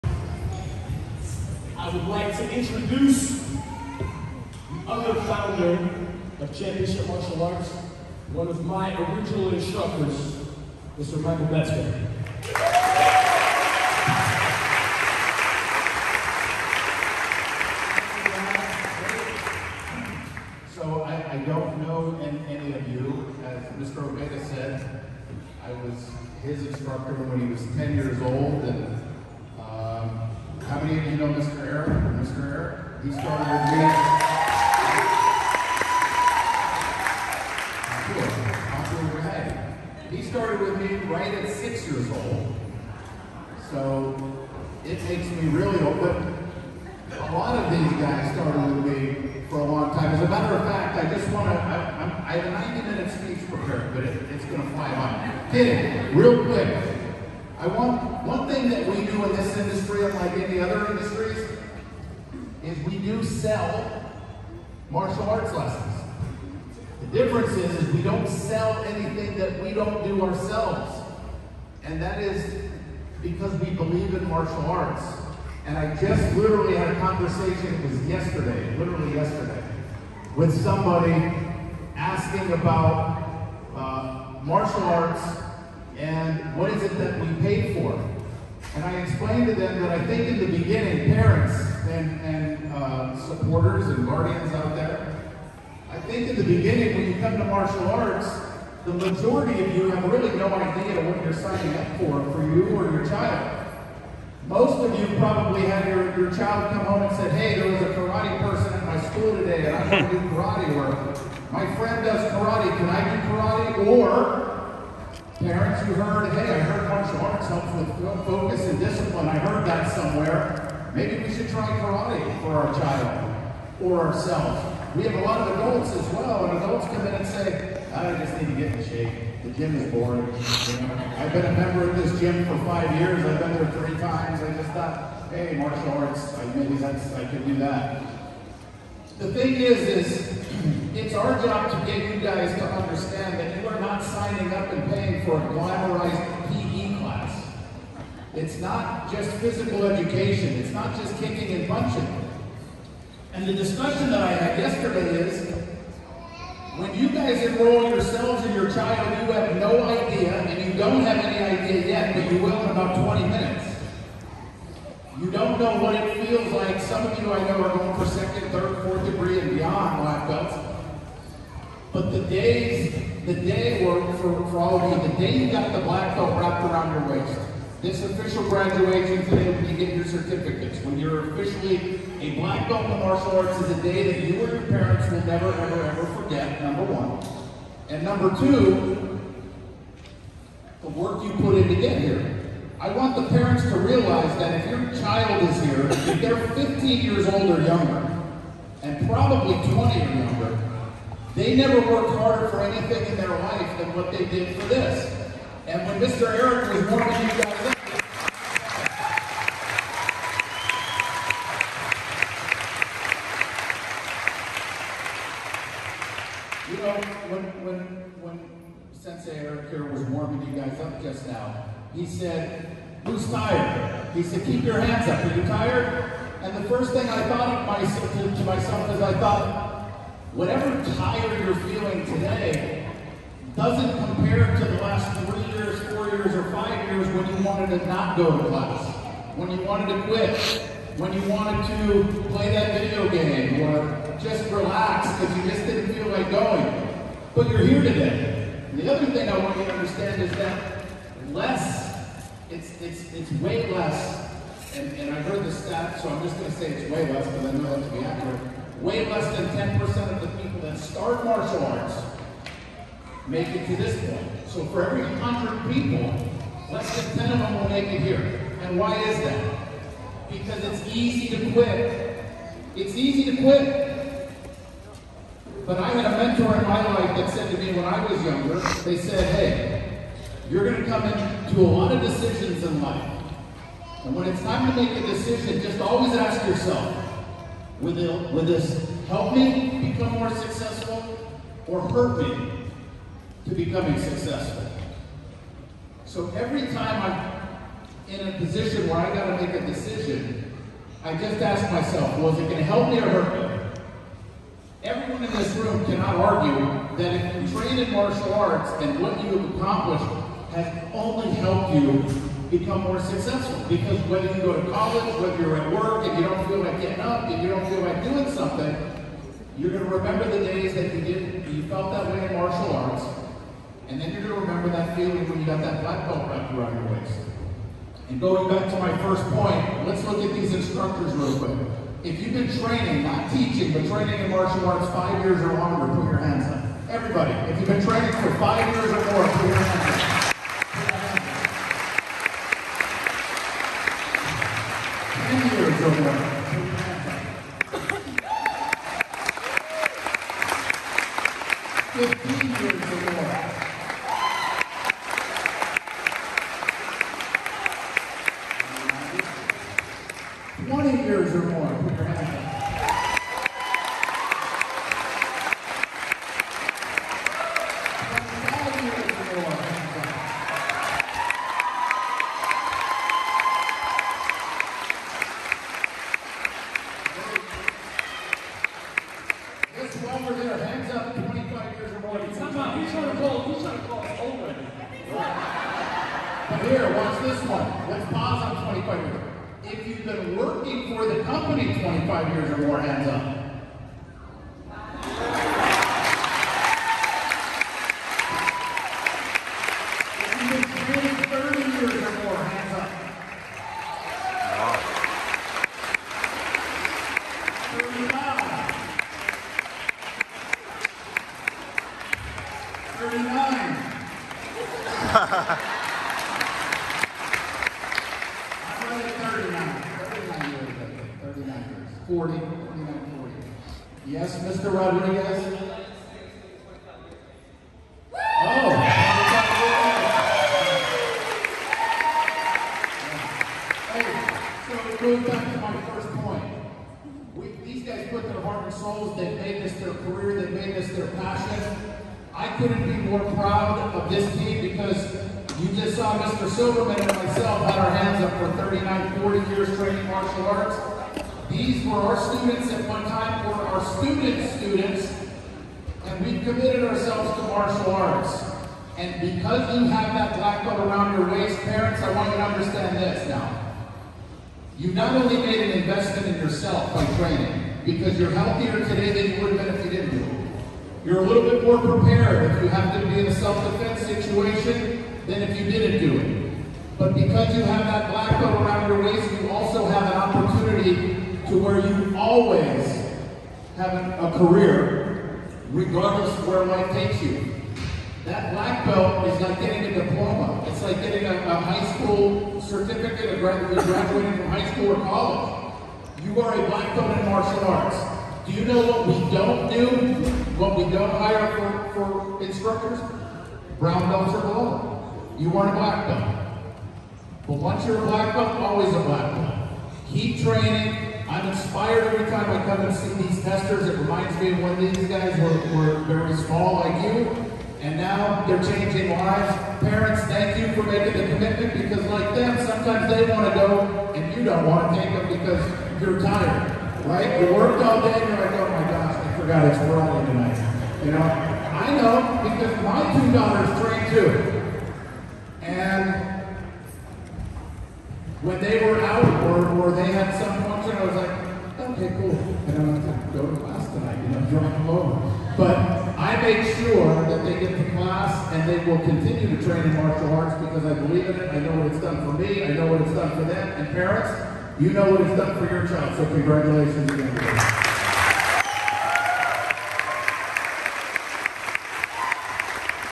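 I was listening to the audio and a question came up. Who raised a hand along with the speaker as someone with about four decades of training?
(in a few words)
Mr. Silverman.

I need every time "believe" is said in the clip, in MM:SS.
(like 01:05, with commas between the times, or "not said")
01:13, 09:10.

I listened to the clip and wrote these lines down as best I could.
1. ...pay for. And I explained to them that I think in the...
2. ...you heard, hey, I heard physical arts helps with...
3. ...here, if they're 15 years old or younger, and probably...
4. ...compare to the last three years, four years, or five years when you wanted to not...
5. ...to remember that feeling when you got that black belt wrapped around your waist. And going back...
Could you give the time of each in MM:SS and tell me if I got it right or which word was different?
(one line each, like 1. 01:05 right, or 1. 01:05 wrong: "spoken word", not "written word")
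1. 01:27 right
2. 01:55 wrong: "martial", not "physical"
3. 03:15 right
4. 03:54 right
5. 05:24 right.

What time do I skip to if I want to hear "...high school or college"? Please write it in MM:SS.
08:14.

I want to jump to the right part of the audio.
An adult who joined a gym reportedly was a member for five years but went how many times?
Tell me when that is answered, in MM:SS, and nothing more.
02:13.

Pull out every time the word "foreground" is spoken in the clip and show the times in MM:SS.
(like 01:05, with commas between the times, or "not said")
not said.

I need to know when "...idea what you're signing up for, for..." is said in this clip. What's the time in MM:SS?
01:40.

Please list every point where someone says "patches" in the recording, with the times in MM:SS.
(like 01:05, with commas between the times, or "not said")
not said.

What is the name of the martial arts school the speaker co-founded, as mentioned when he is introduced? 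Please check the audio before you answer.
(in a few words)
Championship Martial Arts.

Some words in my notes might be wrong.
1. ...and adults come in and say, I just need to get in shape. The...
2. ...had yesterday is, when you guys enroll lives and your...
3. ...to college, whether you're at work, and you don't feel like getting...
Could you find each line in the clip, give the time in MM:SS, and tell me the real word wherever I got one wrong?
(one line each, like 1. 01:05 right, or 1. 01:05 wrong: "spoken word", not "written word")
1. 02:06 right
2. 02:34 wrong: "yourselves", not "lives"
3. 05:14 right.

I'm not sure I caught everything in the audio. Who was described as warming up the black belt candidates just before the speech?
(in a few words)
Sensei Eric.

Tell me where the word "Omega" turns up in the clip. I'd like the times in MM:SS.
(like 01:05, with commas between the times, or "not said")
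00:24.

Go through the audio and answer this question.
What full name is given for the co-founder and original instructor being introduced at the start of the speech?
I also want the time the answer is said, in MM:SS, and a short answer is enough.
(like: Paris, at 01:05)
Michael Metzger, at 00:10.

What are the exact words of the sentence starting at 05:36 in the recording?
Everybody, if you've been training for five years or more, put your hands up.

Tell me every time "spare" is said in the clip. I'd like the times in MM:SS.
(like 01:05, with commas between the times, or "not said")
not said.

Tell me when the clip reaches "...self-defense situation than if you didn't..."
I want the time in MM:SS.
07:53.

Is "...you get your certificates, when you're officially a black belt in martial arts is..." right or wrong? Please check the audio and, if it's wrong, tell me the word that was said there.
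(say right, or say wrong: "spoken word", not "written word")
right.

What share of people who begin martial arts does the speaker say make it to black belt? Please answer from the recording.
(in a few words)
less than 10%.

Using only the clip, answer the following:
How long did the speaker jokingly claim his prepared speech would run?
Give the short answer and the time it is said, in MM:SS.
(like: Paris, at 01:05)
90 minutes, at 00:52.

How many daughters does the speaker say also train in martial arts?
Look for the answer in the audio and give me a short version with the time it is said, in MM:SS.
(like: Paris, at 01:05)
2, at 08:53.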